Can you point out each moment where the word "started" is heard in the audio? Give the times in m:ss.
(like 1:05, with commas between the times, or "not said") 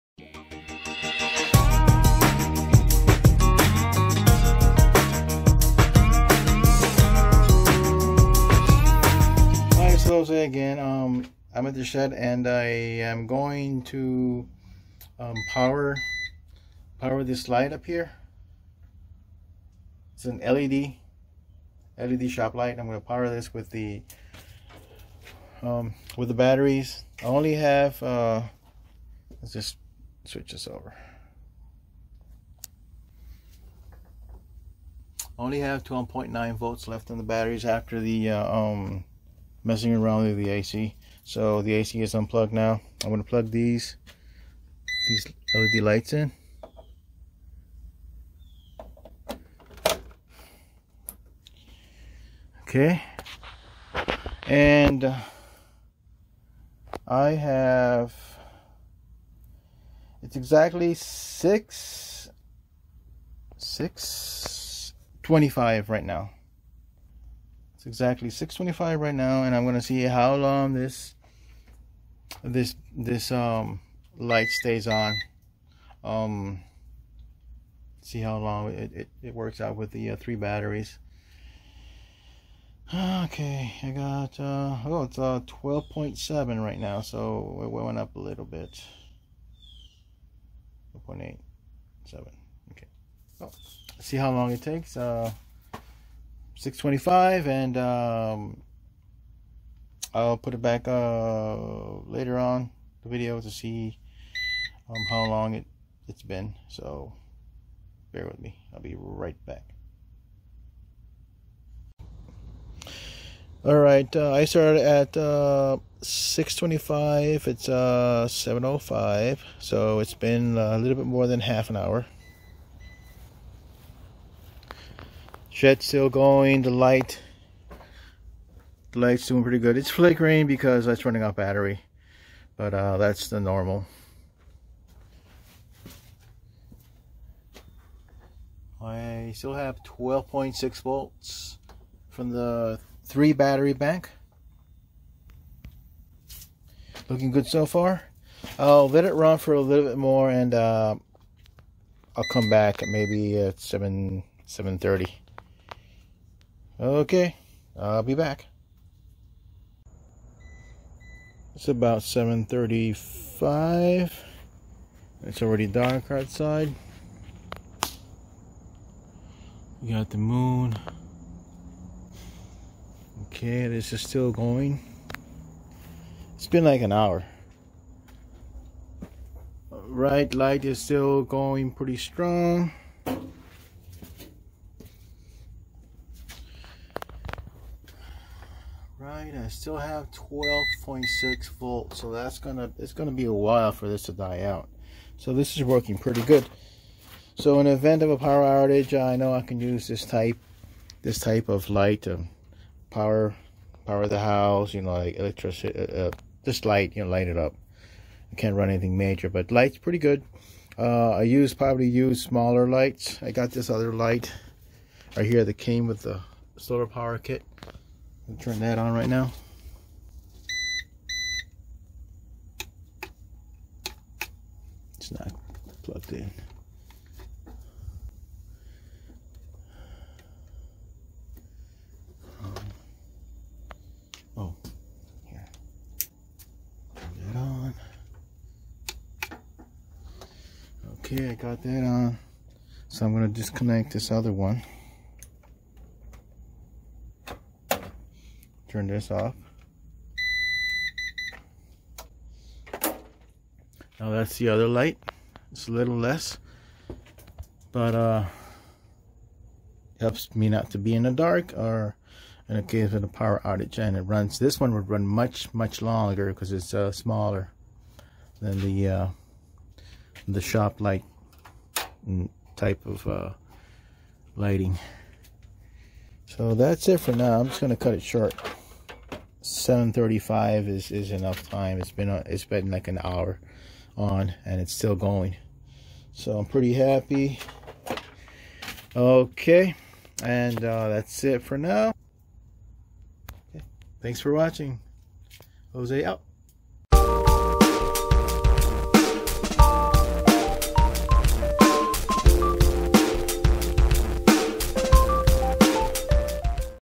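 1:54.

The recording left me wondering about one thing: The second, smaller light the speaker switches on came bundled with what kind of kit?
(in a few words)
solar power kit.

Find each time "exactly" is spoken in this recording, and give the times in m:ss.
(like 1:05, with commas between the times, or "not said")
1:00, 1:07.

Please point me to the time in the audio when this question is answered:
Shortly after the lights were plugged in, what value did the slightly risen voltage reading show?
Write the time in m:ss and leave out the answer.
1:25.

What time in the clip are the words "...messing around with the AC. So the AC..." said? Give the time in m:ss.
0:39.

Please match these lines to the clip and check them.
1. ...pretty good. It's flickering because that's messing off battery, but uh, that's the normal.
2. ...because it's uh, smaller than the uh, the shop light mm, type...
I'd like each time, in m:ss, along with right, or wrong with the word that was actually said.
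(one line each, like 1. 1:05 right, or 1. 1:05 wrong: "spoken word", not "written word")
1. 2:09 wrong: "running", not "messing"
2. 4:26 right.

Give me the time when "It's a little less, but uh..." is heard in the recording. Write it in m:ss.
4:15.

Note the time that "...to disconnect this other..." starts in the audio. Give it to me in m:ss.
4:03.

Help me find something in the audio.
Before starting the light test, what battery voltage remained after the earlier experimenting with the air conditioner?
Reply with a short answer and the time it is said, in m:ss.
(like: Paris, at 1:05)
12.9 volts, at 0:35.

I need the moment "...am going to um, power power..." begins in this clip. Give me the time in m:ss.
0:12.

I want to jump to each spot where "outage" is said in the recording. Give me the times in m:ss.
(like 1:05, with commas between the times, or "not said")
3:18, 4:23.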